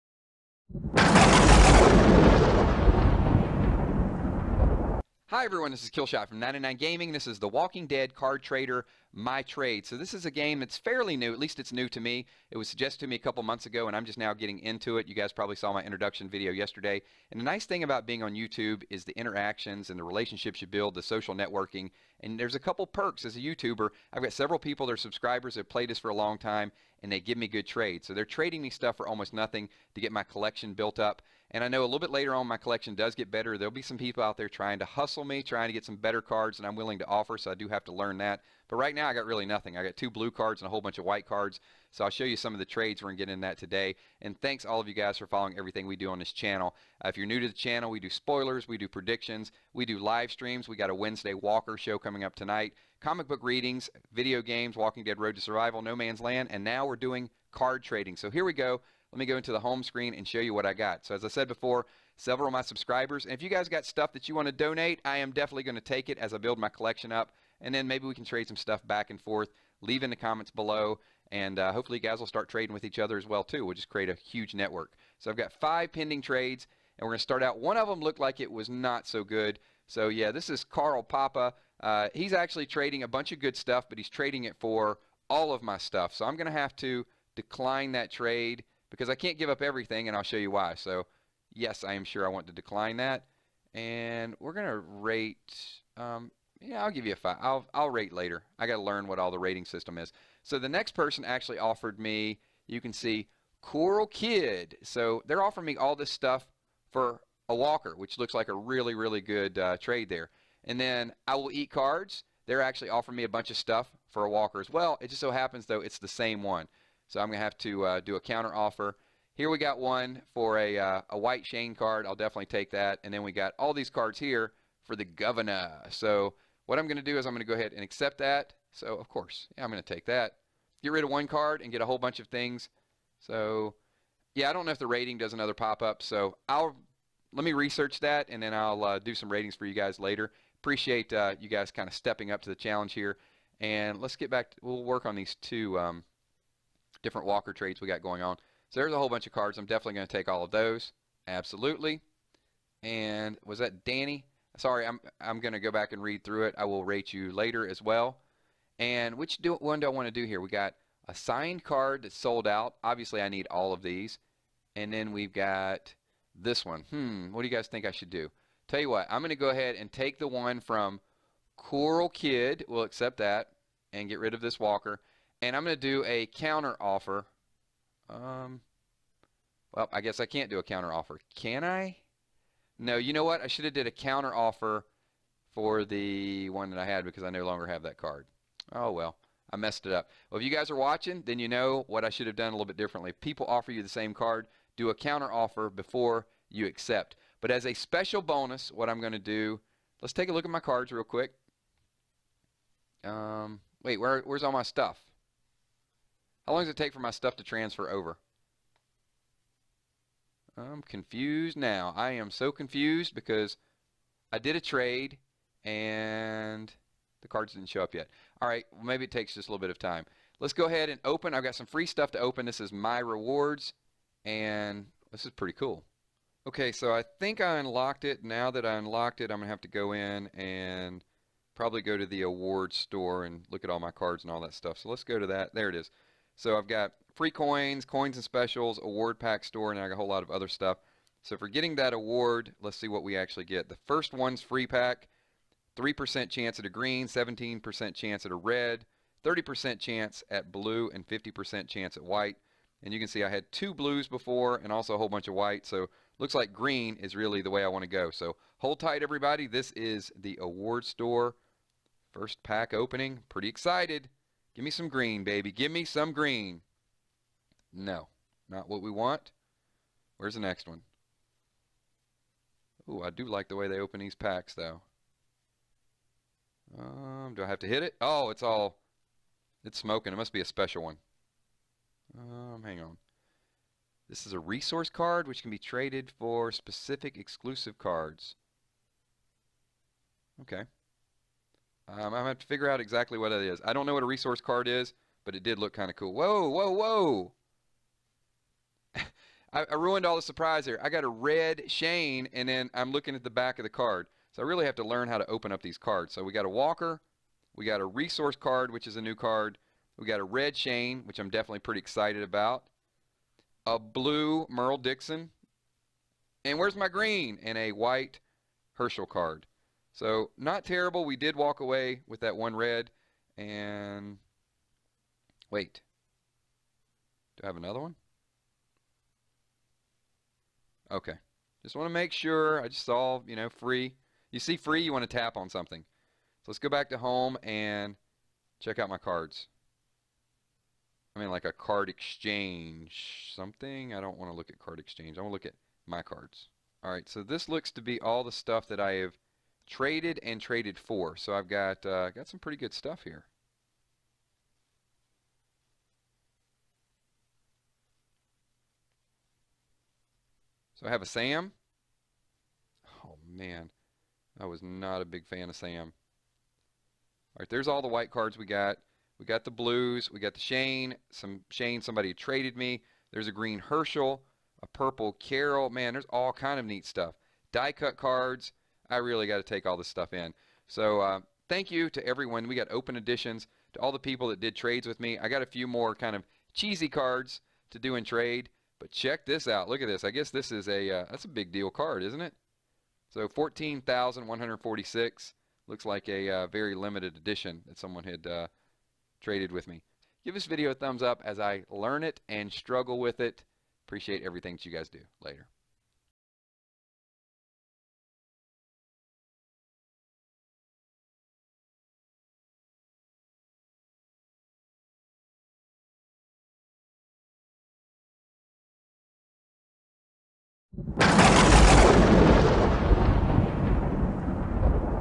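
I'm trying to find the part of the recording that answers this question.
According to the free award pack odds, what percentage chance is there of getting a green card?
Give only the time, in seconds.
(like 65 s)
245 s.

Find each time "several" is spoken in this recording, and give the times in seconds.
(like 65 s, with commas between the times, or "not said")
24 s, 62 s.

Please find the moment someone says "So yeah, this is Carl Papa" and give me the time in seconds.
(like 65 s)
79 s.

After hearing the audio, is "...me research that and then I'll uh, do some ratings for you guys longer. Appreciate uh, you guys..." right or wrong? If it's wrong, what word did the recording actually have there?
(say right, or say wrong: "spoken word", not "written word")
wrong: "later", not "longer".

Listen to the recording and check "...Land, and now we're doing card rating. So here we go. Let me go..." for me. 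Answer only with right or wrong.
wrong.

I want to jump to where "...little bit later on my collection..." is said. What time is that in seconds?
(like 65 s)
31 s.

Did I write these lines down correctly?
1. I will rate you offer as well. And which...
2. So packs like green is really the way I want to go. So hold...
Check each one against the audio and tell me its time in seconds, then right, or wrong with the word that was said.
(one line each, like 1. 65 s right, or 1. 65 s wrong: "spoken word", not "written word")
1. 156 s wrong: "later", not "offer"
2. 255 s wrong: "looks", not "packs".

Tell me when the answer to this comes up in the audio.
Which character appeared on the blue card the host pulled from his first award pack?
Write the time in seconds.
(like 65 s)
314 s.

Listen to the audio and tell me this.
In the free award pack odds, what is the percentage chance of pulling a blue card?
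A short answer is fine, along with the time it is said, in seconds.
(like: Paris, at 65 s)
30%, at 249 s.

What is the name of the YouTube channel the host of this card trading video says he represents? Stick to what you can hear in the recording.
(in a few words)
99 Gaming.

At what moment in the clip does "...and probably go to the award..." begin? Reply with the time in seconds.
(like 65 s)
230 s.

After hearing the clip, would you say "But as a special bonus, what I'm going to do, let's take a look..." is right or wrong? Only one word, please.
right.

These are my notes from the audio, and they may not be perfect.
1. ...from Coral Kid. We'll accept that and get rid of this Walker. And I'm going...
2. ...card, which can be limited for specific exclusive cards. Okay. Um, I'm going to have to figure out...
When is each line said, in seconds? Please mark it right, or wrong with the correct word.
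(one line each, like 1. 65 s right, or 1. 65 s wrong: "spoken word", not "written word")
1. 170 s right
2. 284 s wrong: "traded", not "limited".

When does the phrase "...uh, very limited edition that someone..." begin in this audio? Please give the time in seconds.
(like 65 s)
396 s.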